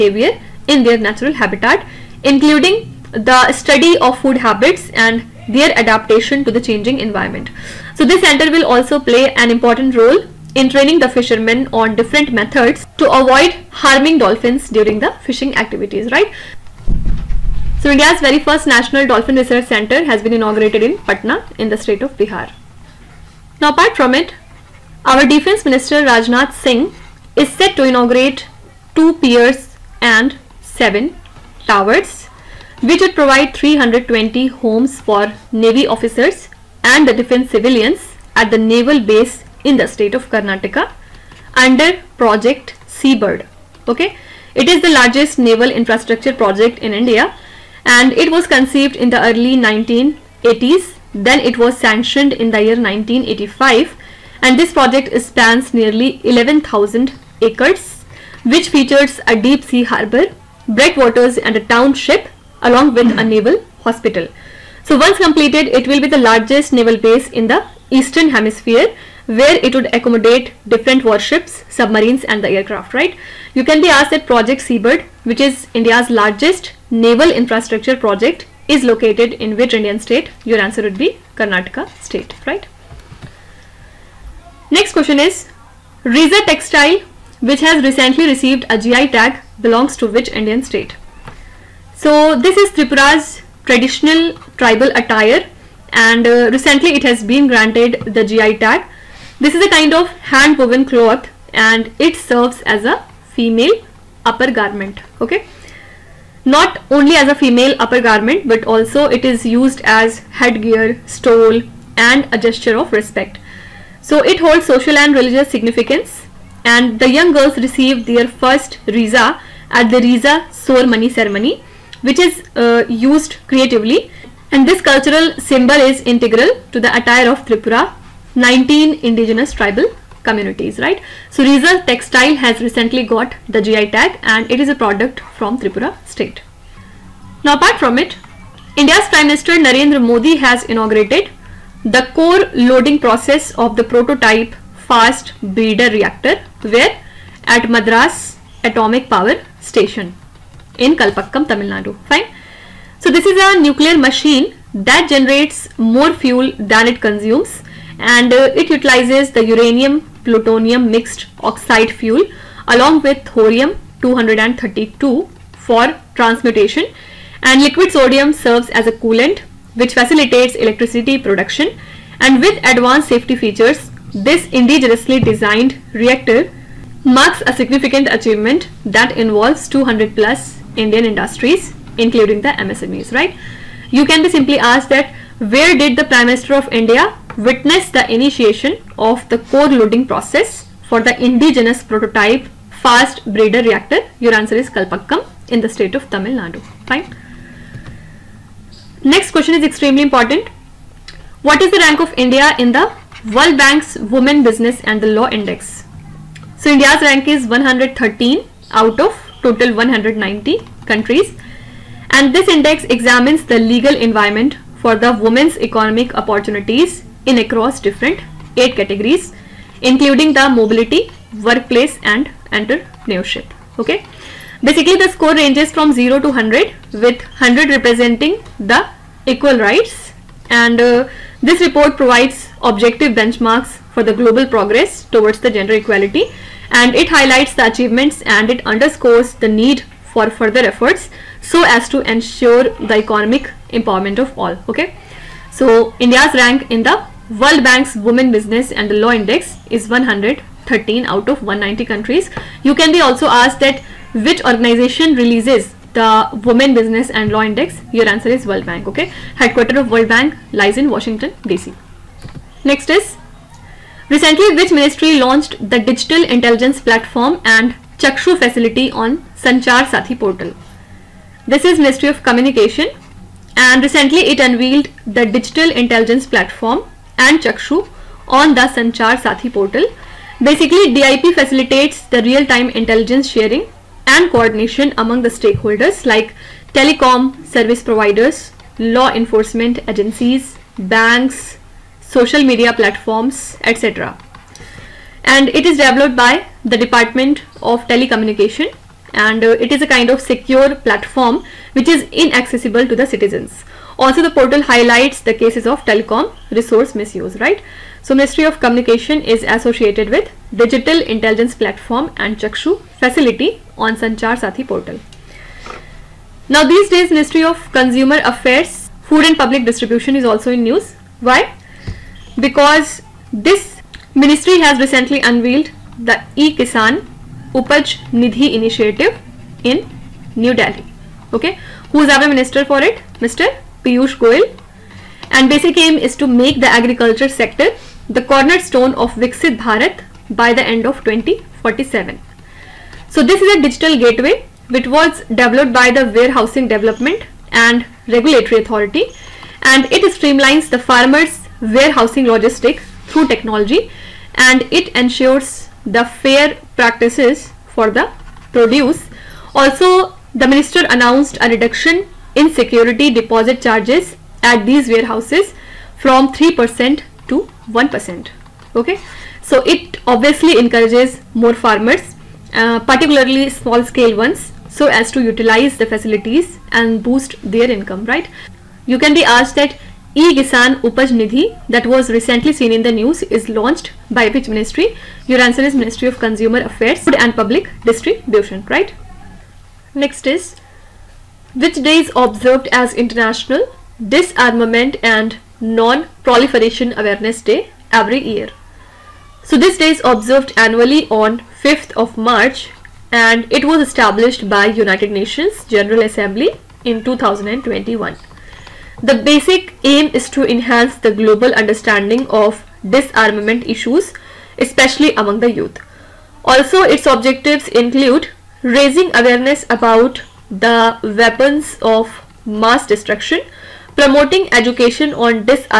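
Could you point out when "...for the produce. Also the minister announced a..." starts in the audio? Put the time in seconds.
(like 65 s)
357 s.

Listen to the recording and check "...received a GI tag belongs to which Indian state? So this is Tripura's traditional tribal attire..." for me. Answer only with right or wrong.
right.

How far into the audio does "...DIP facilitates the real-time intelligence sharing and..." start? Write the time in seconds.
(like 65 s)
280 s.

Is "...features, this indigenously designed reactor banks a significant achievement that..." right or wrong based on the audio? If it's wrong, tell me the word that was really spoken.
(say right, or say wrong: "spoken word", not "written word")
wrong: "marks", not "banks".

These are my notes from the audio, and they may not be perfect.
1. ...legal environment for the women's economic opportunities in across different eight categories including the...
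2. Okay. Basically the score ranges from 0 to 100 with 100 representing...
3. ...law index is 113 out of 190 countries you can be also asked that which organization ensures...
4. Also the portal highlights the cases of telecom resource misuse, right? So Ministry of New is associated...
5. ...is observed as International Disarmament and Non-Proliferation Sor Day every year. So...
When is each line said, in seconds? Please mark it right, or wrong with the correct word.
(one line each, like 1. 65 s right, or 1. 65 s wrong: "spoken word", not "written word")
1. 213 s right
2. 223 s right
3. 248 s wrong: "releases", not "ensures"
4. 303 s wrong: "Communication", not "New"
5. 391 s wrong: "Awareness", not "Sor".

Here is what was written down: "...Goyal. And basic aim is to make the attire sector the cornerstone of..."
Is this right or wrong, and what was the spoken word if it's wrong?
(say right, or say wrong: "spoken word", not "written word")
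wrong: "agriculture", not "attire".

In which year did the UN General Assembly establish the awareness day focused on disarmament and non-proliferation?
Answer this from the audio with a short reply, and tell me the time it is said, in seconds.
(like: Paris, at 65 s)
2021, at 407 s.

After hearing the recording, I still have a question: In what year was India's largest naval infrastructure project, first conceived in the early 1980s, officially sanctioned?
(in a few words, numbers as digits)
1985.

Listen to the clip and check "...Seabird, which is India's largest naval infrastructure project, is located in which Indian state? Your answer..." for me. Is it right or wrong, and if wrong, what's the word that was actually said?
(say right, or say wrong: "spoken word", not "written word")
right.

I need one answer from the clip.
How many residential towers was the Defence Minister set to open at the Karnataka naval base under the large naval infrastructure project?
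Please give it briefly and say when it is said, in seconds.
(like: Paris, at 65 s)
7, at 30 s.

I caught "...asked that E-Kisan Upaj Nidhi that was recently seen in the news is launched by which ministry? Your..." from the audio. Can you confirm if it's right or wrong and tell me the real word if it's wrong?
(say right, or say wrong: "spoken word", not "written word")
right.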